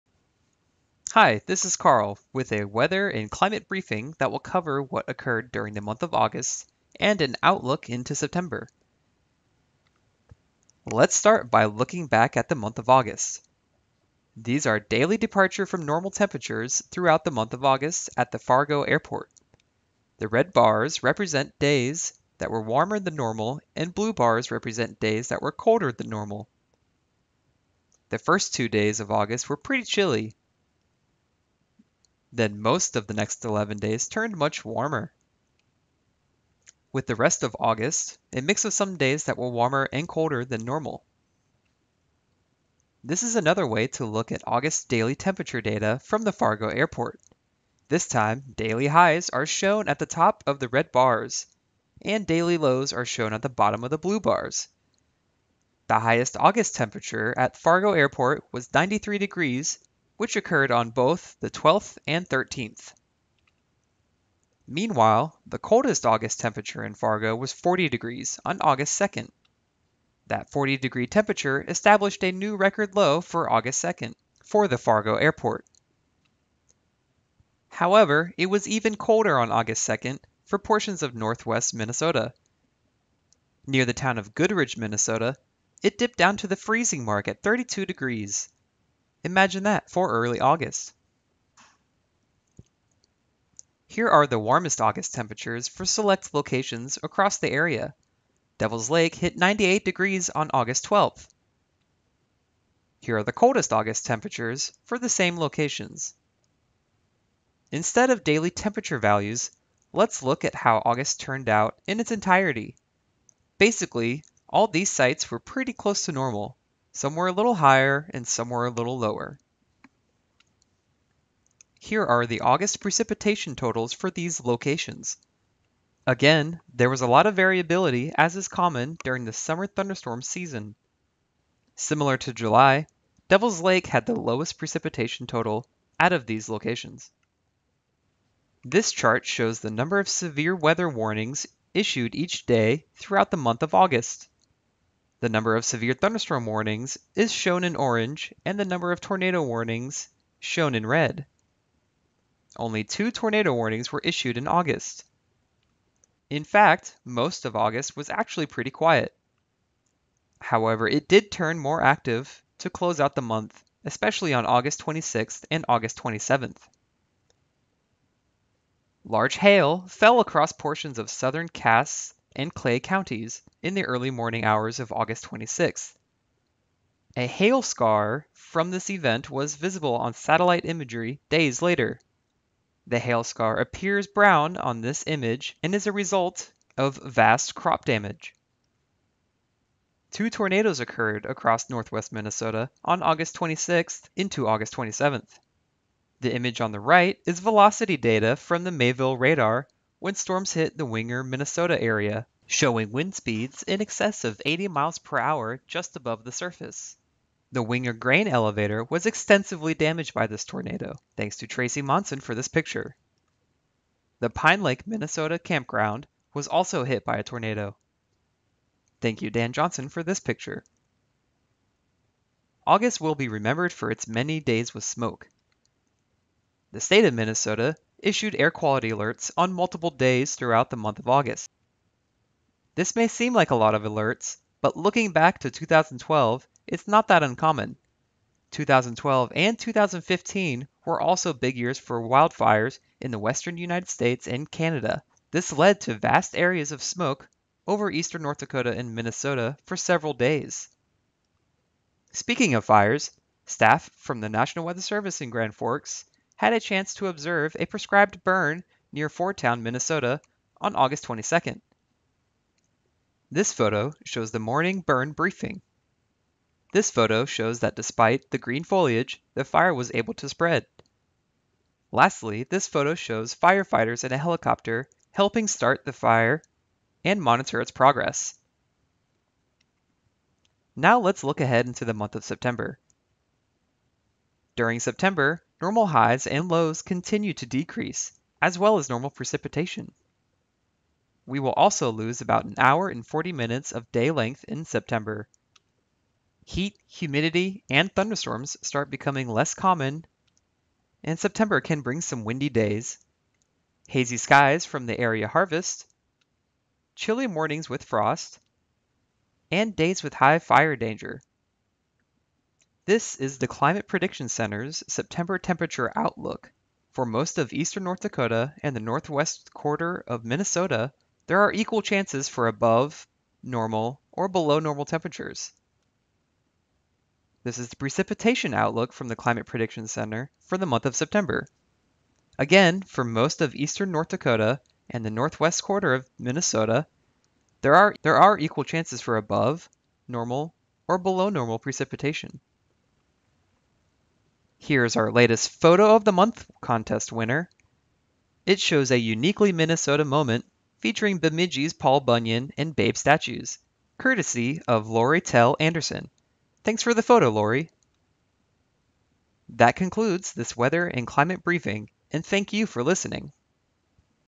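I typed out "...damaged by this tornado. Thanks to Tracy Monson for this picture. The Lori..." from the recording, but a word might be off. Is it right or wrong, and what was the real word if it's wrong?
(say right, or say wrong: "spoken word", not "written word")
wrong: "Pine", not "Lori".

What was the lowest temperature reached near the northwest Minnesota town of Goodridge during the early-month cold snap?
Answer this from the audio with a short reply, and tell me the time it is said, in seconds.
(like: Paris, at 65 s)
32 degrees, at 87 s.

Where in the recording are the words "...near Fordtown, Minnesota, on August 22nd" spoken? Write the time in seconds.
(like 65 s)
258 s.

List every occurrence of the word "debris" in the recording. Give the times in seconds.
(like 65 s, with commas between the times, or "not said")
not said.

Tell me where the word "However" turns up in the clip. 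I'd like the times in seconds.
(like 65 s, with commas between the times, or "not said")
77 s, 160 s.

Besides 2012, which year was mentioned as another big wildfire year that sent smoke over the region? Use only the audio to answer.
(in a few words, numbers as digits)
2015.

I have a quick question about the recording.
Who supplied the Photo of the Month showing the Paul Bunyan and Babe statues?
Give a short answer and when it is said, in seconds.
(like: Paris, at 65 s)
Lori Tell Anderson, at 354 s.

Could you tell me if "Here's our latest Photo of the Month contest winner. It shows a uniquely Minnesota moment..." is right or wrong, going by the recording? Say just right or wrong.
right.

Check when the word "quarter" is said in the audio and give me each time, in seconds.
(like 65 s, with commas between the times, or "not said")
319 s, 335 s.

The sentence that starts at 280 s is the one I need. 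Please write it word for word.
Now let's look ahead into the month of September.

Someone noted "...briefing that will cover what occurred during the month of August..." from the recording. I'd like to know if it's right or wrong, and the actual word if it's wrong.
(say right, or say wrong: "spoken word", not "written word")
right.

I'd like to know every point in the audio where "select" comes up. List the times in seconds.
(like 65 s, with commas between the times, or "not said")
95 s.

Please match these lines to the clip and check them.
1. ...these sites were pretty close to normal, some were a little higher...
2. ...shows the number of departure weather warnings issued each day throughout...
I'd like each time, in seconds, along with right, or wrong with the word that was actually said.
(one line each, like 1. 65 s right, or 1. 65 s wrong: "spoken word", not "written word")
1. 114 s right
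2. 139 s wrong: "severe", not "departure".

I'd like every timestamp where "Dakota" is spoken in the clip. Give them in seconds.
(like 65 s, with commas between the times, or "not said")
248 s, 317 s, 334 s.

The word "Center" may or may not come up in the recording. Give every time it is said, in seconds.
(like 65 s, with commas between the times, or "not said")
314 s, 329 s.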